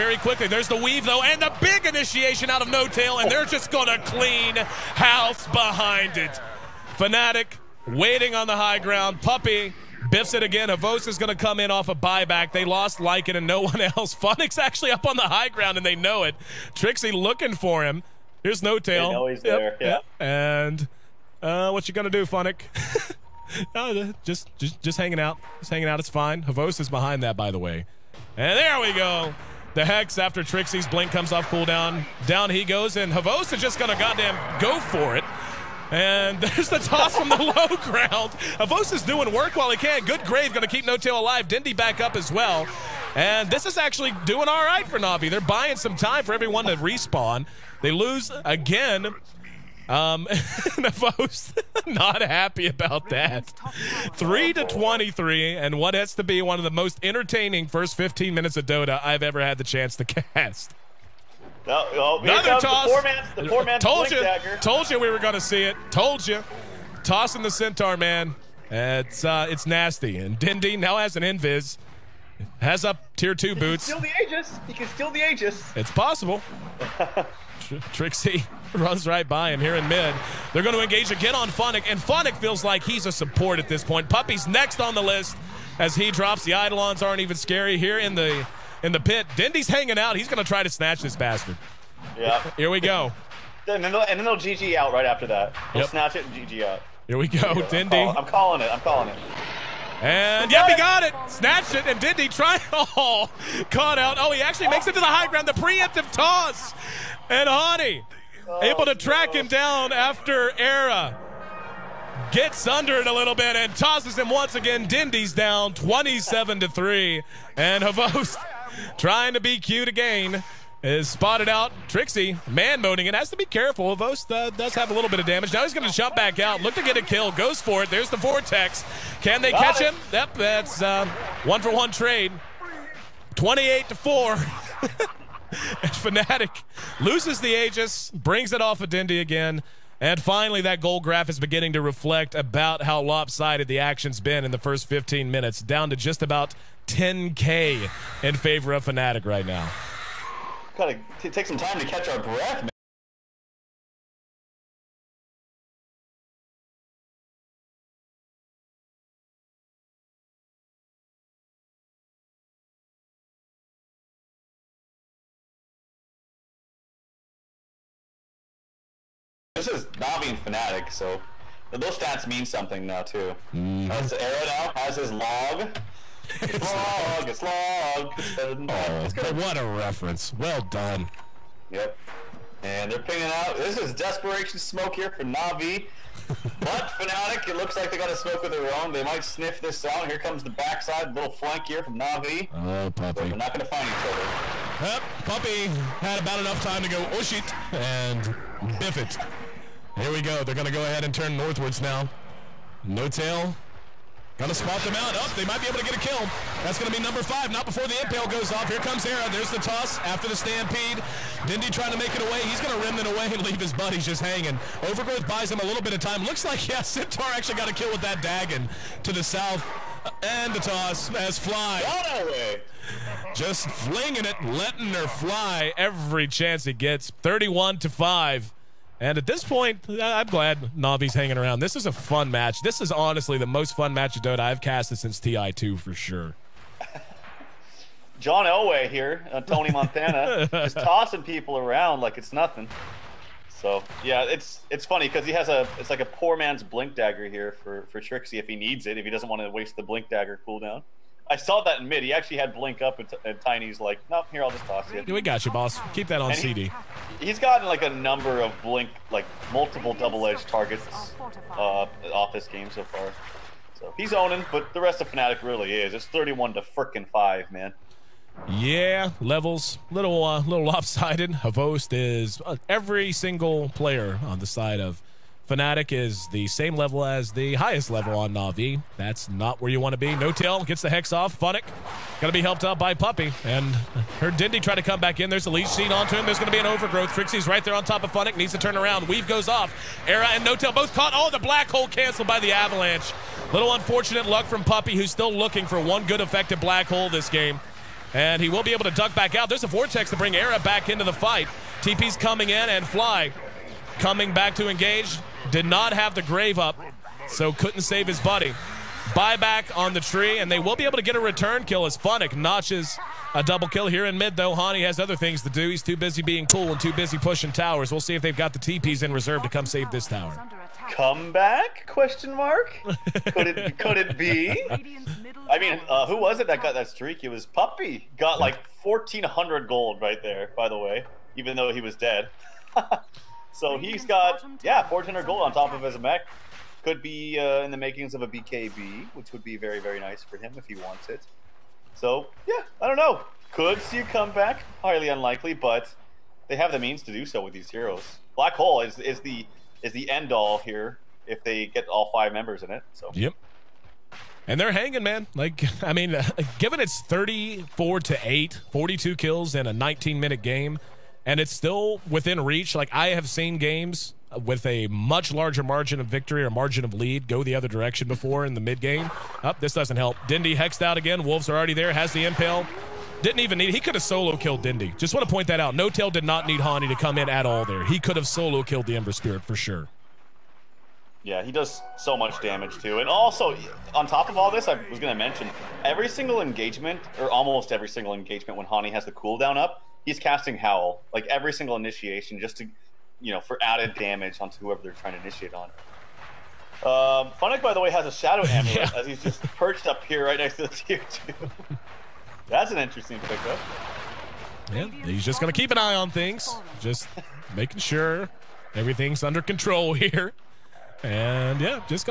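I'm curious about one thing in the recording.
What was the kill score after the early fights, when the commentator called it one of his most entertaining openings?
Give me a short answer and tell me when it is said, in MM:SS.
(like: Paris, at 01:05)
3 to 23, at 00:54.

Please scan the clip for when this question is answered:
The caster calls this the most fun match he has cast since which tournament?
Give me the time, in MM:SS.
03:55.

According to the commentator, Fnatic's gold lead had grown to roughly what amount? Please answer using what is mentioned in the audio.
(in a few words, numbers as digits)
10K.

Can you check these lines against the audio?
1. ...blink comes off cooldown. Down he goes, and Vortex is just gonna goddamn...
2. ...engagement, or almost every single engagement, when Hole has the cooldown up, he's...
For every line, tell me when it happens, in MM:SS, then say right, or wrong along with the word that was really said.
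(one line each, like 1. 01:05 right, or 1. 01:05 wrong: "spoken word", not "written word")
1. 00:30 wrong: "Havos", not "Vortex"
2. 06:26 wrong: "Hani", not "Hole".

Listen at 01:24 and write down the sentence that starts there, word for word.
Puppy's next on the list as he drops.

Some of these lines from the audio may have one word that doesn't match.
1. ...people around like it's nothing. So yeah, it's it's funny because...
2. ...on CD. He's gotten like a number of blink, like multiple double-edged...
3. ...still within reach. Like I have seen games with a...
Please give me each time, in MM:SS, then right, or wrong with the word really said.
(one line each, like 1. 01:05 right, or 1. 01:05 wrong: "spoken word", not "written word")
1. 04:01 right
2. 04:16 right
3. 06:01 right.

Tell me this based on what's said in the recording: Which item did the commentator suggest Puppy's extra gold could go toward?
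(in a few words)
BKB.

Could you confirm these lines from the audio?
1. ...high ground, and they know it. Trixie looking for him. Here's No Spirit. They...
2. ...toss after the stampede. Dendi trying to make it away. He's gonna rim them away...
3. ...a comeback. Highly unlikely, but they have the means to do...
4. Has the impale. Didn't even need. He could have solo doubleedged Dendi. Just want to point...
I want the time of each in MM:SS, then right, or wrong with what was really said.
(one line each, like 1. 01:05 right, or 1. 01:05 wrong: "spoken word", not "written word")
1. 00:15 wrong: "Tail", not "Spirit"
2. 03:29 right
3. 05:43 right
4. 06:11 wrong: "killed", not "doubleedged".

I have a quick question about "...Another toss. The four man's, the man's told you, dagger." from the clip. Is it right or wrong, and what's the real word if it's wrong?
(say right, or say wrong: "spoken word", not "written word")
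right.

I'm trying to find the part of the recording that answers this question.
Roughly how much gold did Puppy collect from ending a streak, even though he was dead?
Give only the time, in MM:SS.
05:28.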